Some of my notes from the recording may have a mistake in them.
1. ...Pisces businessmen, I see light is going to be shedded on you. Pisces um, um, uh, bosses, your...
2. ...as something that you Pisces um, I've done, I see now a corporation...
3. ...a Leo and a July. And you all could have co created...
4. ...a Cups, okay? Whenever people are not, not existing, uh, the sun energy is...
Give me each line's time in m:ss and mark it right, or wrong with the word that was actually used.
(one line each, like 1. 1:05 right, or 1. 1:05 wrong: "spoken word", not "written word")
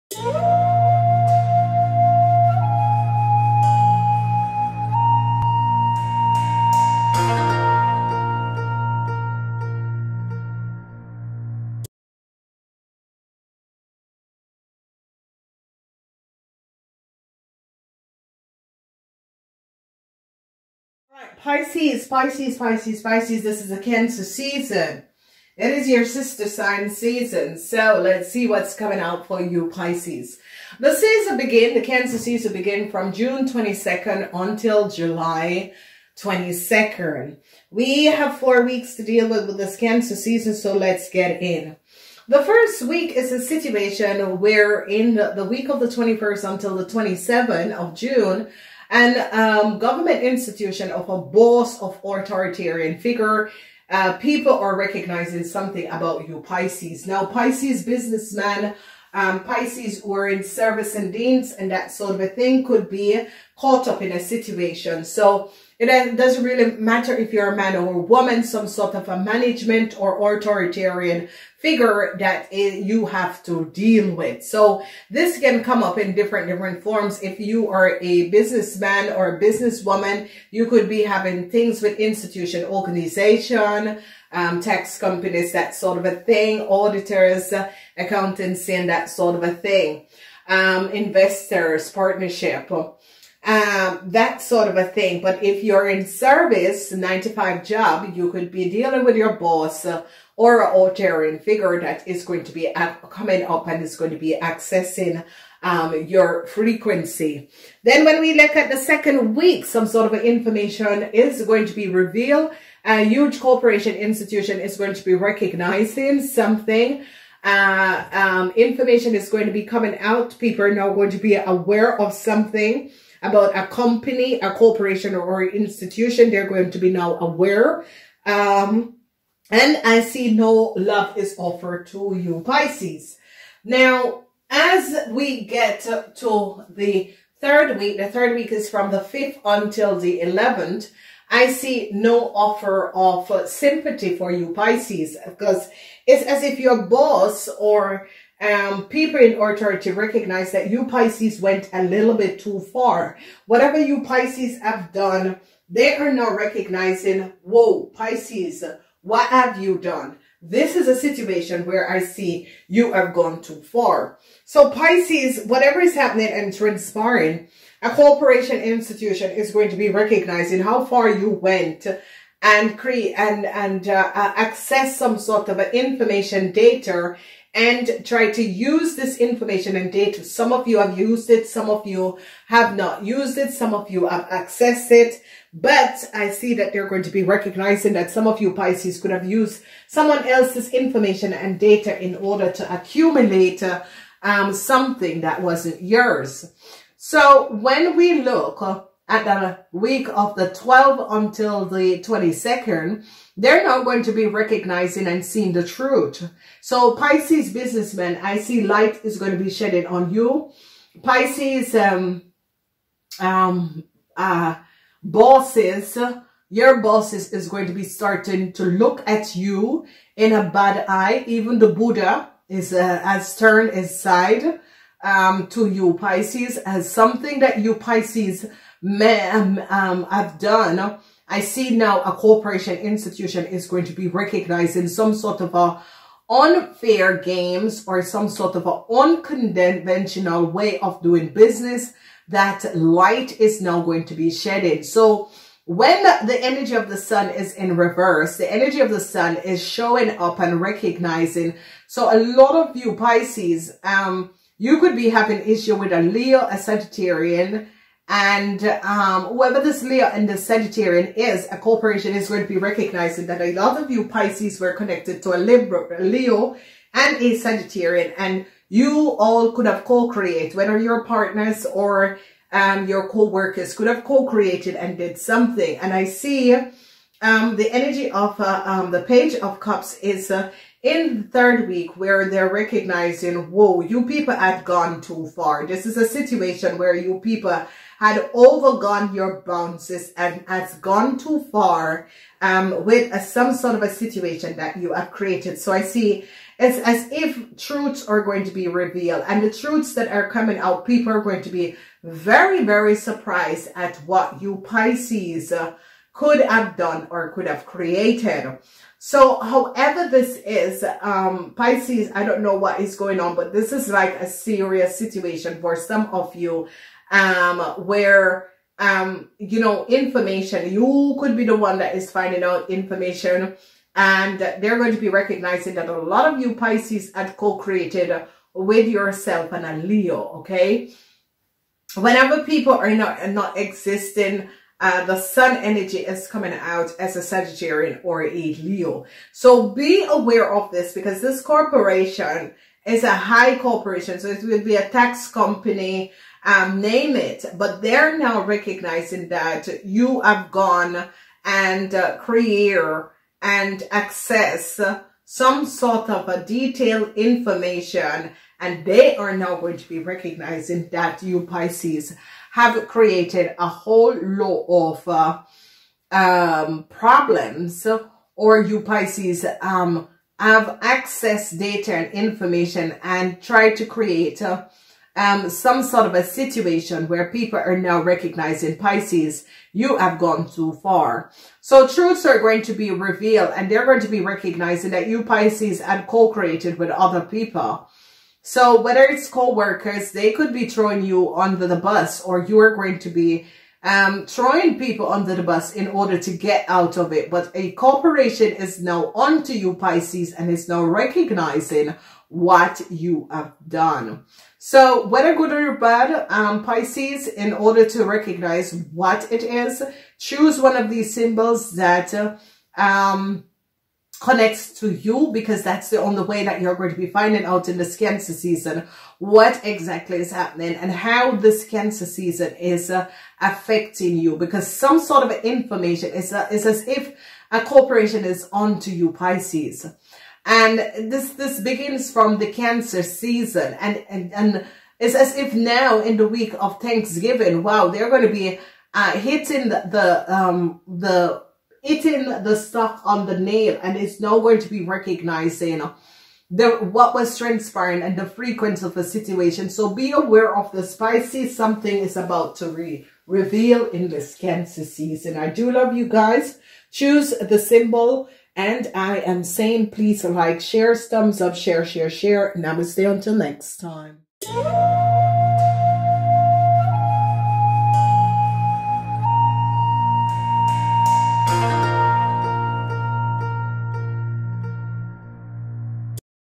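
1. 3:26 right
2. 3:46 right
3. 4:25 wrong: "Sagittarian", not "July"
4. 5:29 wrong: "Leo", not "Cups".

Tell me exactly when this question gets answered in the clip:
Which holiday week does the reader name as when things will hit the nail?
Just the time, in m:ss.
7:16.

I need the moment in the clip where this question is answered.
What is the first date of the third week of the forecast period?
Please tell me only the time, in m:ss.
2:18.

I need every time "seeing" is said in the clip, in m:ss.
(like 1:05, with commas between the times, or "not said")
3:25.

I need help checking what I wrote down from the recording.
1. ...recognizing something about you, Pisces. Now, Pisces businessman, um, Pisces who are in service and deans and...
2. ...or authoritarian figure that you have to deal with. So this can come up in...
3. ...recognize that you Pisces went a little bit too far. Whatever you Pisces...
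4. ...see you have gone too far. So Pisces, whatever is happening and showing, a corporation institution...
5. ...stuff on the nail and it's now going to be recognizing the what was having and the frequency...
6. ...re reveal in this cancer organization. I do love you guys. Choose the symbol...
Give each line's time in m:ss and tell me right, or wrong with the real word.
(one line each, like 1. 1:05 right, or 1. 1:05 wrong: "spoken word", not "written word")
1. 0:54 right
2. 1:10 right
3. 2:29 right
4. 2:41 wrong: "transpiring", not "showing"
5. 7:22 wrong: "transpiring", not "having"
6. 7:32 wrong: "season", not "organization".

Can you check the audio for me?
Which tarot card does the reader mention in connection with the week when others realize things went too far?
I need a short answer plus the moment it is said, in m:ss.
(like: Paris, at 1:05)
Page of Cups, at 4:39.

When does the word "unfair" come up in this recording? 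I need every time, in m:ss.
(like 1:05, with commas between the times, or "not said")
3:56.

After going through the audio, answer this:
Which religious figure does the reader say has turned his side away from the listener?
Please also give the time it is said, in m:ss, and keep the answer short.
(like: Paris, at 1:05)
Buddha, at 3:41.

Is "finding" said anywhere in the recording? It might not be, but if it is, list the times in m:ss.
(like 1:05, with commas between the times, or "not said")
5:22, 6:57.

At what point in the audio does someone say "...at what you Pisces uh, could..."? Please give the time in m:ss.
5:03.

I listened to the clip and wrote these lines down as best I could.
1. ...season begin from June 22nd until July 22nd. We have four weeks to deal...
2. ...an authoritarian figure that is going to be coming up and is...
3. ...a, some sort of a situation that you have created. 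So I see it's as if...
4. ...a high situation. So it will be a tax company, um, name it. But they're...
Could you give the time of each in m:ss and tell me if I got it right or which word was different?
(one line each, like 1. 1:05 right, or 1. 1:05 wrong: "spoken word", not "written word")
1. 0:32 right
2. 1:40 right
3. 4:53 right
4. 5:43 wrong: "corporation", not "situation".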